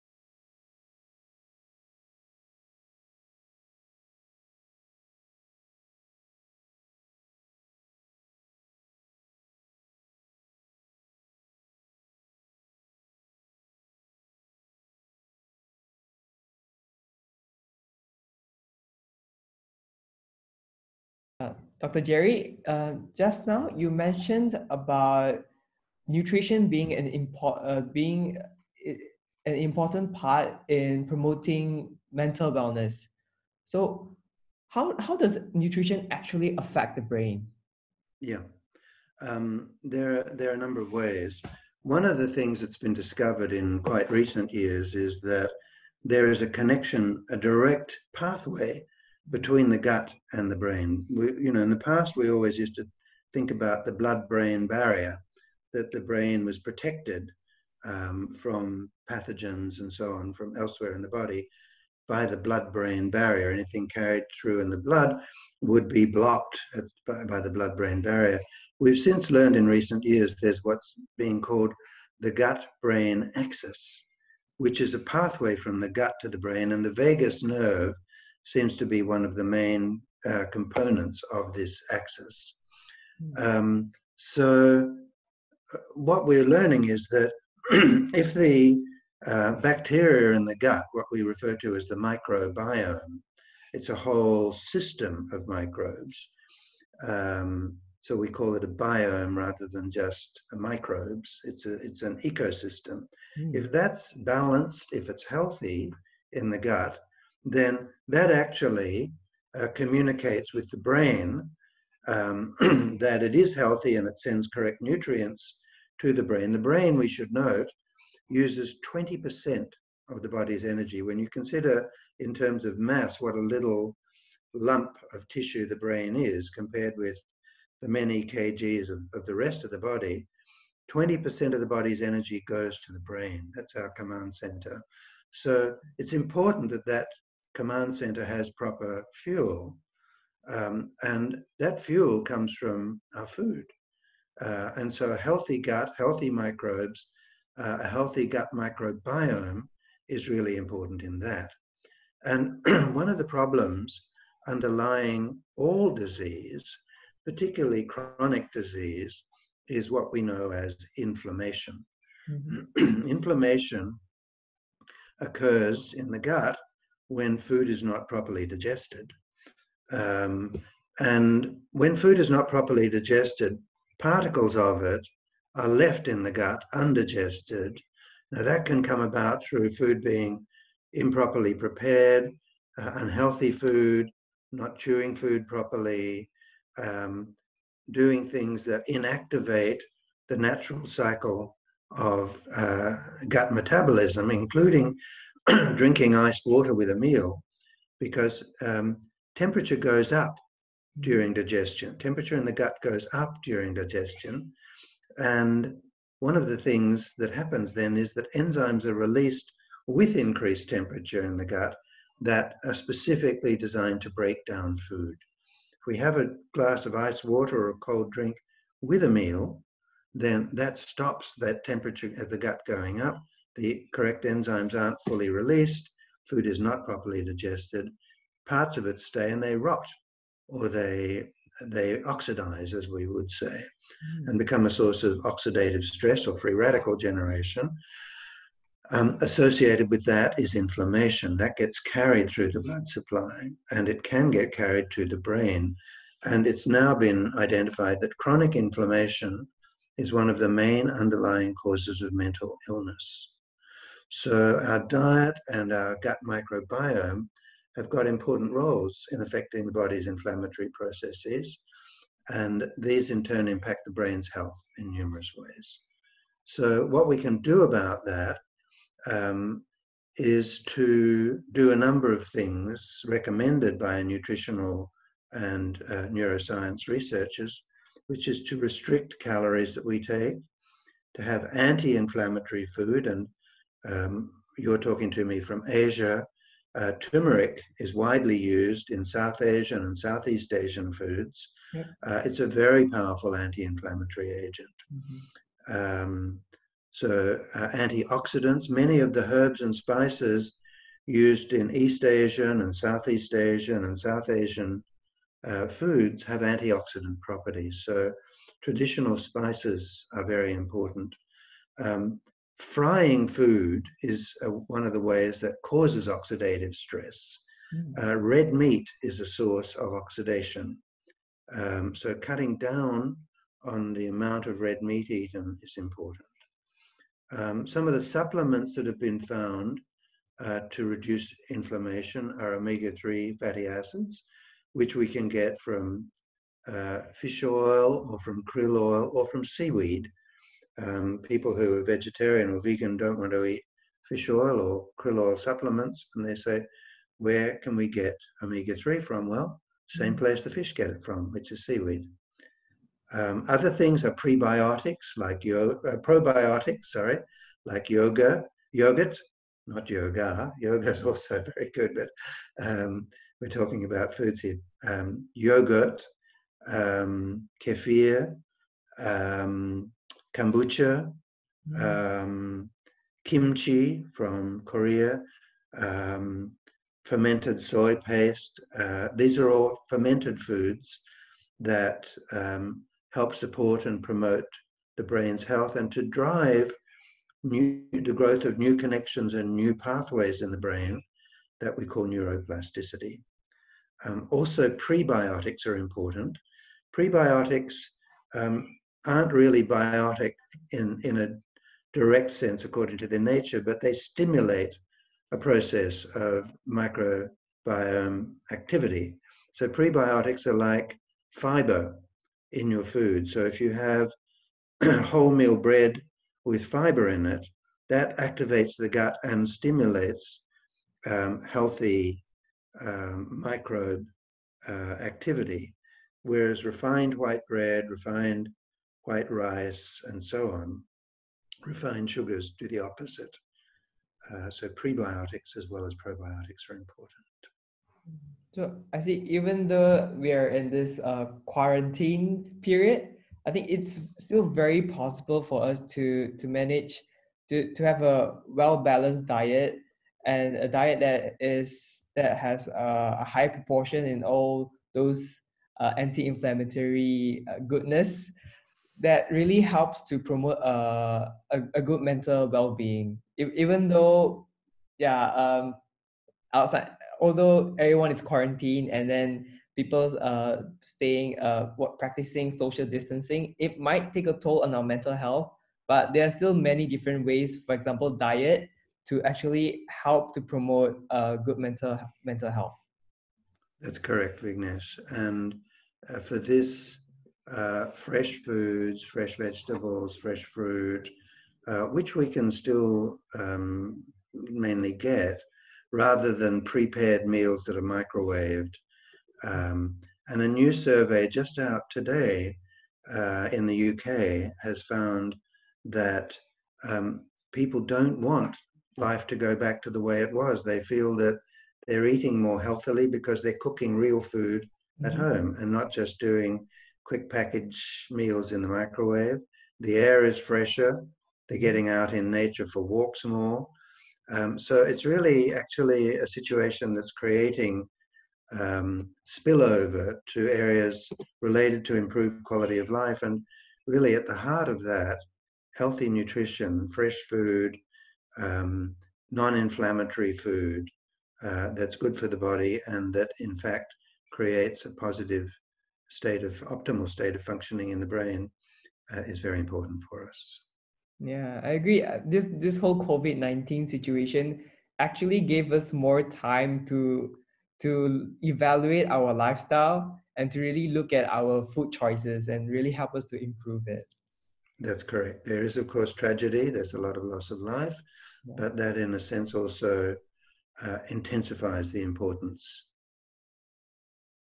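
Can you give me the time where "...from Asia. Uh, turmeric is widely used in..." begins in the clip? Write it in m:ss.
4:45.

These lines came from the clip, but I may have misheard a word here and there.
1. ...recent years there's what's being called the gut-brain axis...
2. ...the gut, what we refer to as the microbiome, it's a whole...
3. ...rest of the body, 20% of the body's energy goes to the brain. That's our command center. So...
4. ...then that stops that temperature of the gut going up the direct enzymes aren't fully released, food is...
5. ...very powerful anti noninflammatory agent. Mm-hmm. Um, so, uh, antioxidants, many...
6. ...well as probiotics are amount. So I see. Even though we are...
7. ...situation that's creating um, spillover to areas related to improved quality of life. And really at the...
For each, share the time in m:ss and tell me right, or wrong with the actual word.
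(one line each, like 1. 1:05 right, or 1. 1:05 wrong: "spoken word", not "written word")
1. 1:09 right
2. 1:30 right
3. 2:09 right
4. 3:40 wrong: "correct", not "direct"
5. 4:52 wrong: "inflammatory", not "noninflammatory"
6. 7:15 wrong: "important", not "amount"
7. 8:46 right.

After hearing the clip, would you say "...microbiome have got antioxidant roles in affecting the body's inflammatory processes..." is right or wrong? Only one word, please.
wrong.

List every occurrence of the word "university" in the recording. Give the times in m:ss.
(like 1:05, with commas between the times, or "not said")
not said.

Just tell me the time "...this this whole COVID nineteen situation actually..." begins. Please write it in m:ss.
9:12.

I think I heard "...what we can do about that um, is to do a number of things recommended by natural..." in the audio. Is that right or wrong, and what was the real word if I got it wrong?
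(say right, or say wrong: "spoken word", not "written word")
wrong: "nutritional", not "natural".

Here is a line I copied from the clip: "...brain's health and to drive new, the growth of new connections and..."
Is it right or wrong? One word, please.
right.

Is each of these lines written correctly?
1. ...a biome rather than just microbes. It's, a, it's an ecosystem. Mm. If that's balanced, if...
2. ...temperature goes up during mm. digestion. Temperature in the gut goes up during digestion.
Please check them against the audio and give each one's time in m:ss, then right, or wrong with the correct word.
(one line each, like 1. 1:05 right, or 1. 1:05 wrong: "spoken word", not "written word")
1. 1:38 right
2. 3:19 right.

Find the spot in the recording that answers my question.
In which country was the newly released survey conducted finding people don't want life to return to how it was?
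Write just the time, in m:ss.
8:23.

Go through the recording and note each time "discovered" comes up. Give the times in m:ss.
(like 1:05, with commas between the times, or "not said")
0:42.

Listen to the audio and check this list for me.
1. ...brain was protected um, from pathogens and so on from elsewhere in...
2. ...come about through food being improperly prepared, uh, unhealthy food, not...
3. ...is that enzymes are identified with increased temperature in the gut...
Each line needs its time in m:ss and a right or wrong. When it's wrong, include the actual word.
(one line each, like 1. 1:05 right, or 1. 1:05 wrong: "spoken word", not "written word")
1. 0:56 right
2. 2:58 right
3. 3:27 wrong: "released", not "identified".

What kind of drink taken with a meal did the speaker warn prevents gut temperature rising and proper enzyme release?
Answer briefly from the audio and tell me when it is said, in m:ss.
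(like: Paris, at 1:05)
iced water, at 3:16.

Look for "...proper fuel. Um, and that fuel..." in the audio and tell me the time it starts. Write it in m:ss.
2:18.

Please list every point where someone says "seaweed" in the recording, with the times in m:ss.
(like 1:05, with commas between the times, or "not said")
5:39, 5:51.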